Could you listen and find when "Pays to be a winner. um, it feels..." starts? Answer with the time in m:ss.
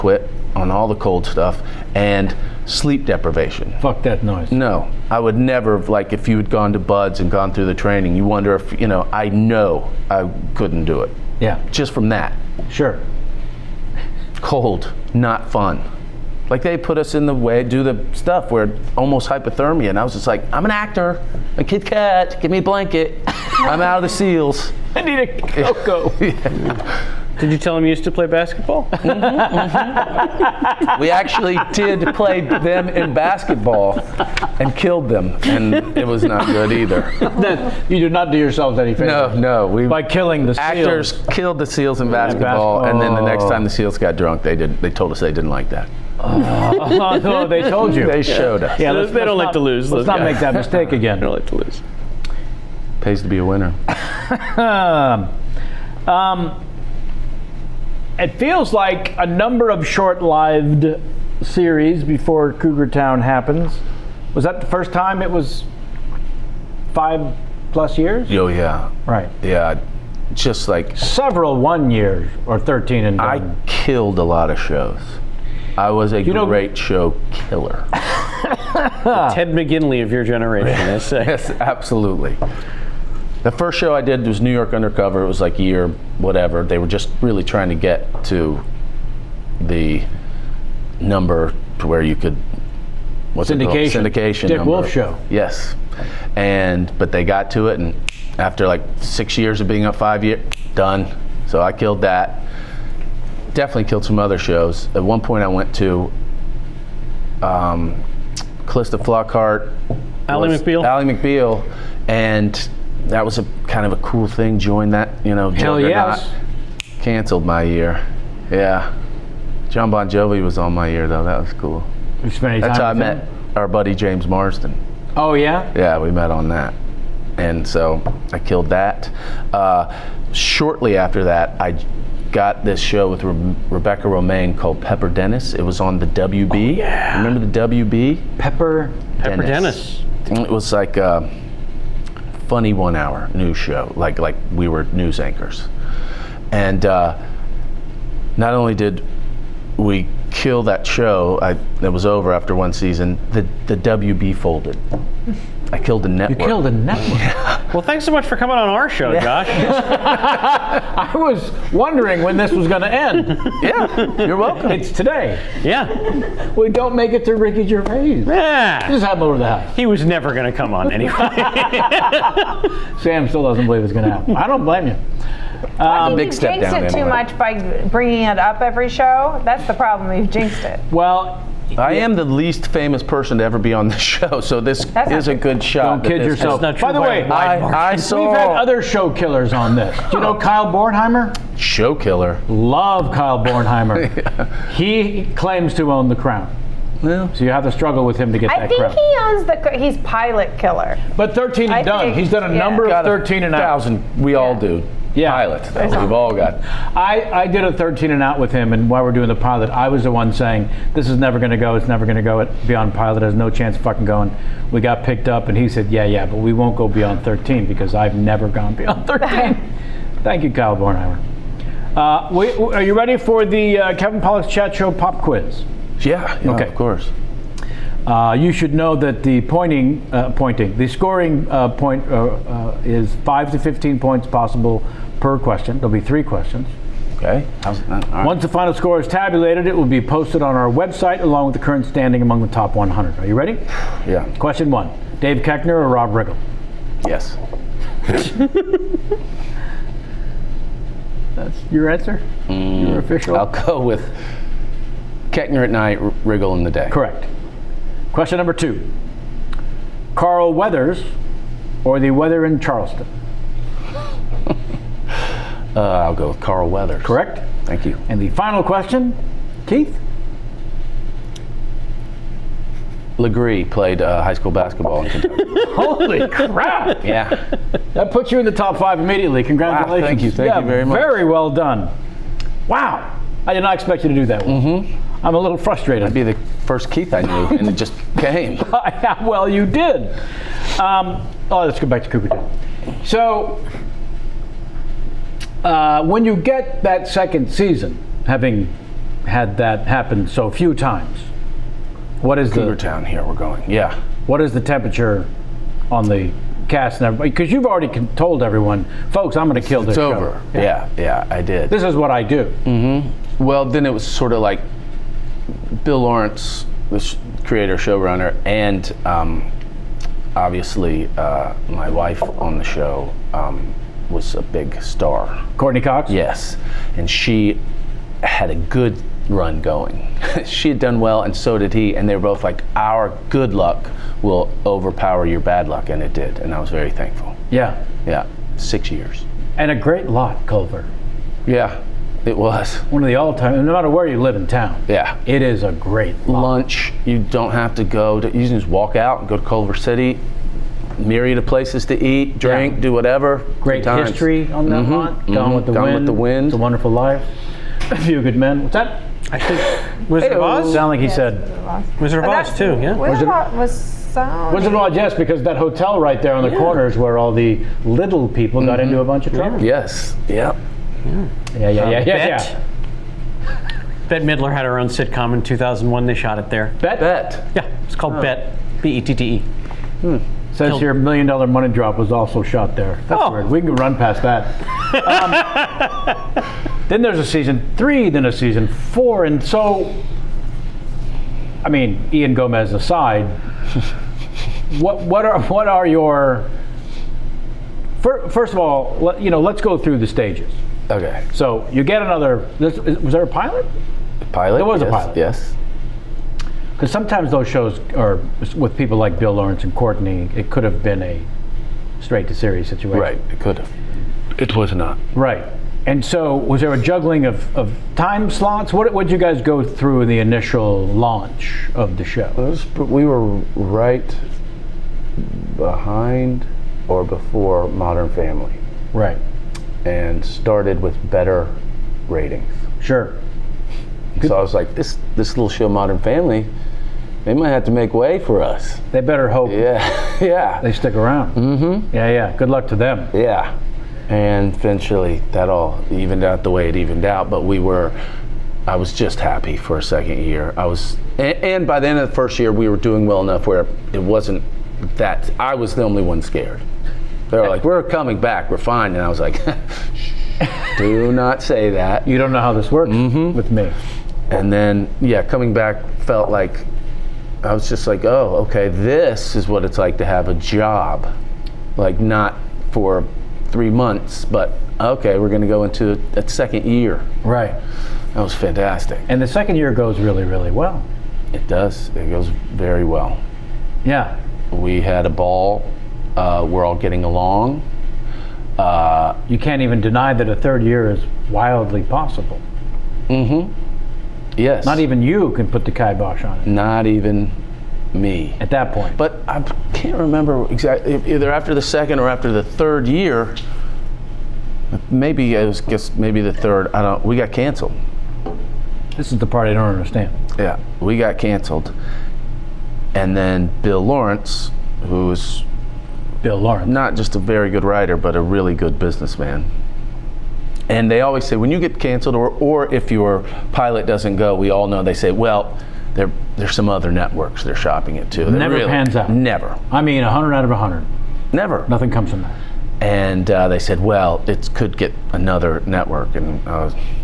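0:53.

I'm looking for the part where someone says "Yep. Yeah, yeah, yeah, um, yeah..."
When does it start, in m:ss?
6:10.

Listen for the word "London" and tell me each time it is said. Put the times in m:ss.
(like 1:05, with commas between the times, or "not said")
not said.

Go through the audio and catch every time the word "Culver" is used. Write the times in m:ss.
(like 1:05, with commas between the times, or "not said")
5:40, 5:49.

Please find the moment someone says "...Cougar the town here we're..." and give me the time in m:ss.
5:02.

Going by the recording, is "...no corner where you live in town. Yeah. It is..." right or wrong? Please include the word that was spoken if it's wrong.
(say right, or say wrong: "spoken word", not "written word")
wrong: "matter", not "corner".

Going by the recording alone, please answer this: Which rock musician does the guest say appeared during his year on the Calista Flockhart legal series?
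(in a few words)
John Bon Jovi.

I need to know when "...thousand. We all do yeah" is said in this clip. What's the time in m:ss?
3:23.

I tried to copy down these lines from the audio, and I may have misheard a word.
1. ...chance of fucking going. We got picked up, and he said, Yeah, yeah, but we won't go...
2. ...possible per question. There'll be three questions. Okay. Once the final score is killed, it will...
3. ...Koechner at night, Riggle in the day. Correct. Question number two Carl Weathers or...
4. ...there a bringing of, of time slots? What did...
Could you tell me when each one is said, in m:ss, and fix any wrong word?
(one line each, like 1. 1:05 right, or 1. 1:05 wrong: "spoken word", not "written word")
1. 3:33 right
2. 3:54 wrong: "tabulated", not "killed"
3. 4:15 right
4. 6:56 wrong: "juggling", not "bringing".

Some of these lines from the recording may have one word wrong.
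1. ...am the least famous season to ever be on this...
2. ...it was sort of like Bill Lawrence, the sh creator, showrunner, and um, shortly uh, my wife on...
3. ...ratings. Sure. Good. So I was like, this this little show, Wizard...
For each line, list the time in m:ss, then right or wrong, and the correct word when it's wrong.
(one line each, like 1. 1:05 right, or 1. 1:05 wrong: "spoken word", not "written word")
1. 3:01 wrong: "person", not "season"
2. 5:13 wrong: "obviously", not "shortly"
3. 7:12 wrong: "Modern", not "Wizard".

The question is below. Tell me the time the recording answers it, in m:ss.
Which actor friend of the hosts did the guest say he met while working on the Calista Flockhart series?
2:03.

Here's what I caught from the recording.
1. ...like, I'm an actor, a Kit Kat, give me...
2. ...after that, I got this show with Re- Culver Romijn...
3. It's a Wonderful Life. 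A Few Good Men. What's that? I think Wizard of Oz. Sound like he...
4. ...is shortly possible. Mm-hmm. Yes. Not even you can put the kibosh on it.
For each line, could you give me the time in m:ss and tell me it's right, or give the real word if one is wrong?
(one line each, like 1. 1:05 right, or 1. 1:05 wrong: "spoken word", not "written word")
1. 0:20 right
2. 2:10 wrong: "Rebecca", not "Culver"
3. 5:56 right
4. 8:10 wrong: "wildly", not "shortly".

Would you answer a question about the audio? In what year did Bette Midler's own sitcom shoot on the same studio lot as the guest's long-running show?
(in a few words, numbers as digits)
2001.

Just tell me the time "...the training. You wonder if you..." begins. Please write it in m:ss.
0:07.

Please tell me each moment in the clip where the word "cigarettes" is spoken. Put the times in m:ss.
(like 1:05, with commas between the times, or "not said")
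not said.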